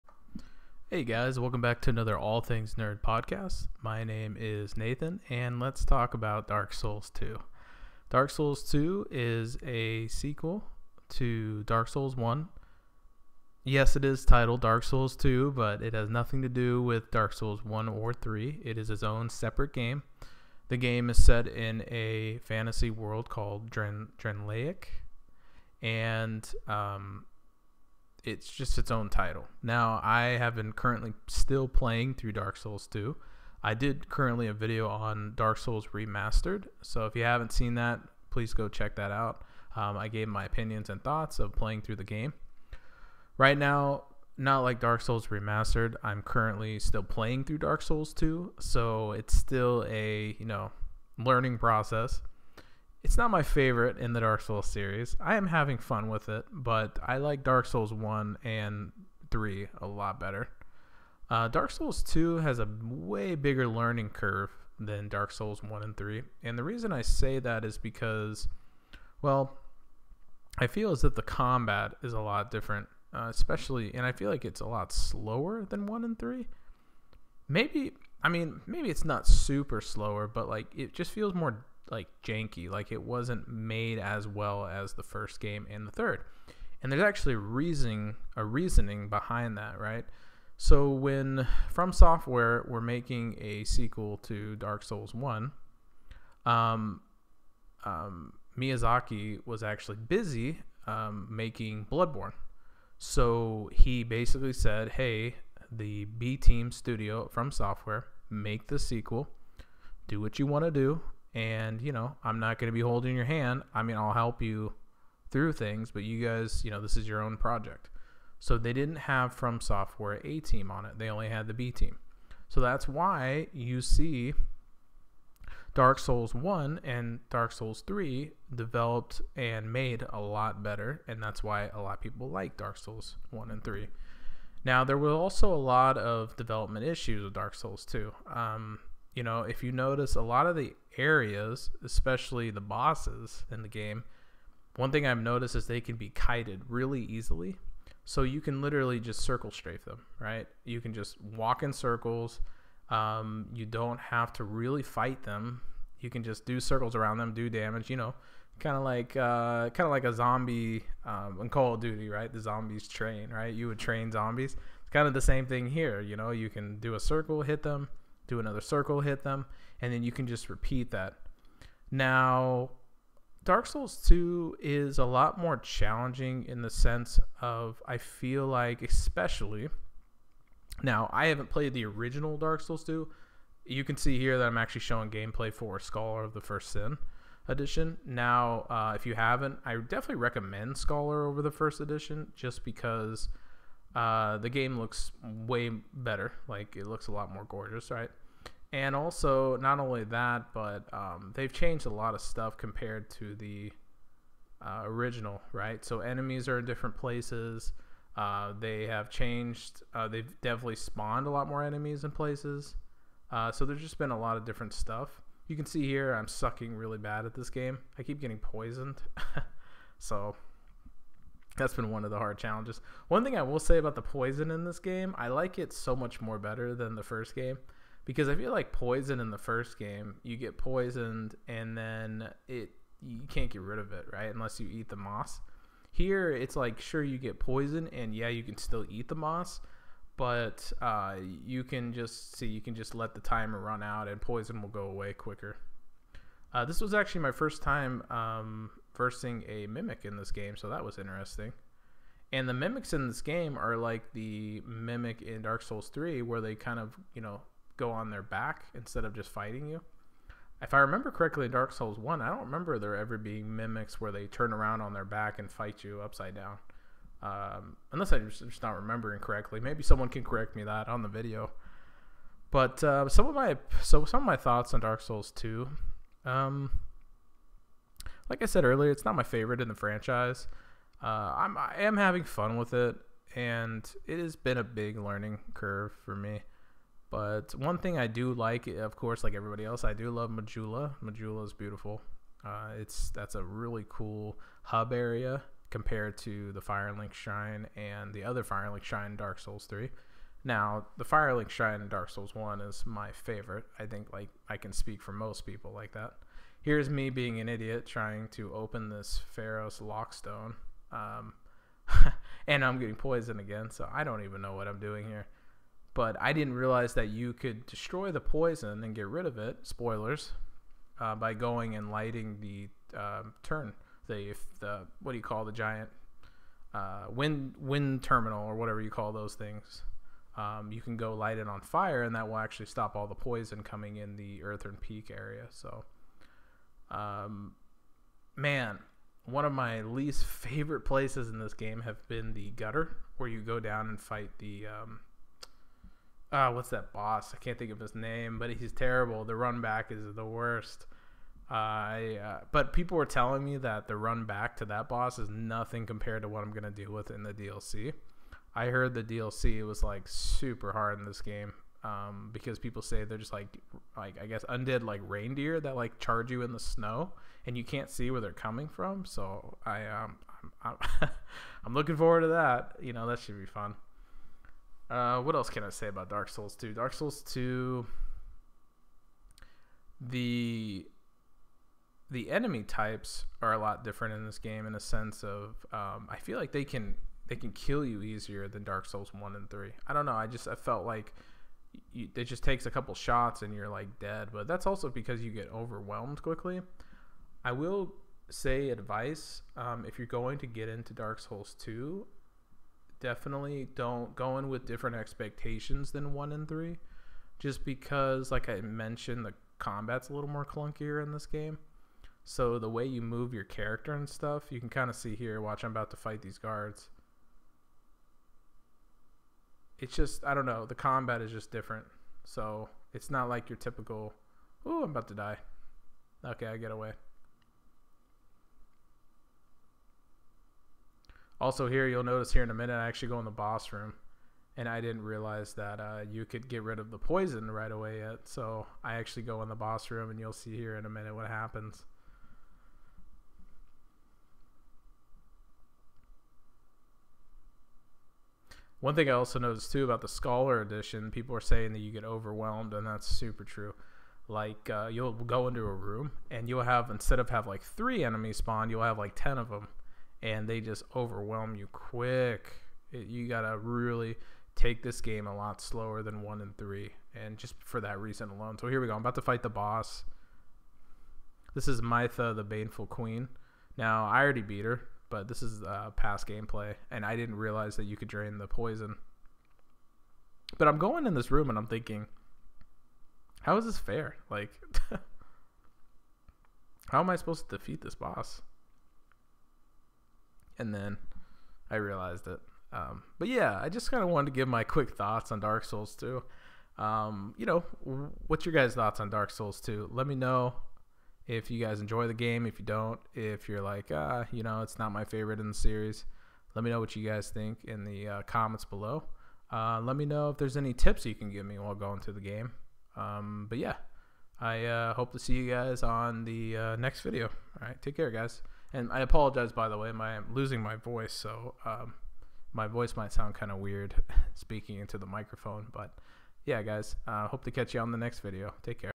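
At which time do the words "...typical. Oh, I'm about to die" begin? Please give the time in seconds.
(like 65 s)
423 s.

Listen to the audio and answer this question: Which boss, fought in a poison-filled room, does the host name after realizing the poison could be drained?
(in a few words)
Mytha, the Baneful Queen.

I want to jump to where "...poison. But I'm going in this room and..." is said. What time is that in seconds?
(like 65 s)
478 s.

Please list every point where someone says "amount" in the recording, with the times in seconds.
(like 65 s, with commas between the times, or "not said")
not said.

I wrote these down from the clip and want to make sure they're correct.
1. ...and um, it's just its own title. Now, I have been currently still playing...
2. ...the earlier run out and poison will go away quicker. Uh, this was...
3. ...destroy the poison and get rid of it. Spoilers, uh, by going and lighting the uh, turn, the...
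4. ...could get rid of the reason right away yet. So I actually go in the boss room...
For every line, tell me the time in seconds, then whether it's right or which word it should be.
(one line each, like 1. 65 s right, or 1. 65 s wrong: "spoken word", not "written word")
1. 25 s right
2. 243 s wrong: "timer", not "earlier"
3. 317 s right
4. 436 s wrong: "poison", not "reason".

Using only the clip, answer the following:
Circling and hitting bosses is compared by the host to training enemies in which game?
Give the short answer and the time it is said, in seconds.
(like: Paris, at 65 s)
Call of Duty, at 161 s.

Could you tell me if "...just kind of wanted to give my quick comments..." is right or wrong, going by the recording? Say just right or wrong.
wrong.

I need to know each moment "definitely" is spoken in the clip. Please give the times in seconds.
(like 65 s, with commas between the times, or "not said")
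189 s, 210 s, 403 s.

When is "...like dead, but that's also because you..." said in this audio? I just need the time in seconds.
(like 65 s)
393 s.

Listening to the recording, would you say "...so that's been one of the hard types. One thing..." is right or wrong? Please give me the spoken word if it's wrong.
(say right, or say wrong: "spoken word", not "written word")
wrong: "challenges", not "types".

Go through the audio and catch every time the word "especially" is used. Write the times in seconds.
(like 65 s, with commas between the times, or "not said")
73 s, 141 s, 178 s.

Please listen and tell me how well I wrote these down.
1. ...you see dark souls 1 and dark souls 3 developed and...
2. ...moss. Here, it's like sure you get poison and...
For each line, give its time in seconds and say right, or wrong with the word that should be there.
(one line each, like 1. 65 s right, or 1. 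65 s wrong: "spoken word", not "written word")
1. 123 s right
2. 234 s right.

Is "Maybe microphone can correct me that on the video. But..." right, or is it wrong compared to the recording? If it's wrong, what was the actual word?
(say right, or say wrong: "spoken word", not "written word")
wrong: "someone", not "microphone".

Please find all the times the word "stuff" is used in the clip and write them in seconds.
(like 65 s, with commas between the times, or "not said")
202 s, 214 s, 414 s.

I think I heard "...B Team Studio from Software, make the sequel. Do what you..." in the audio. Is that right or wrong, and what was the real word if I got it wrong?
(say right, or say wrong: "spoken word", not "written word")
right.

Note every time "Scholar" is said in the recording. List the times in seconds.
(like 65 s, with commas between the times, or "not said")
185 s, 190 s, 450 s.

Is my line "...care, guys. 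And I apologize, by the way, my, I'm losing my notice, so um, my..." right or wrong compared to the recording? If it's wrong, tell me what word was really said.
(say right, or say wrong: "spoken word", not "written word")
wrong: "voice", not "notice".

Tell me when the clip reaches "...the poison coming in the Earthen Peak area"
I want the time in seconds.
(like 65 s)
333 s.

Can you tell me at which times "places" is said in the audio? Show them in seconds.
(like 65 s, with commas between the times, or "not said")
206 s, 212 s, 340 s.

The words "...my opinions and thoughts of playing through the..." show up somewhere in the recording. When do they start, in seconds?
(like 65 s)
40 s.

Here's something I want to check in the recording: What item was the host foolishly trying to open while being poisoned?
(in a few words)
Pharros' Lockstone.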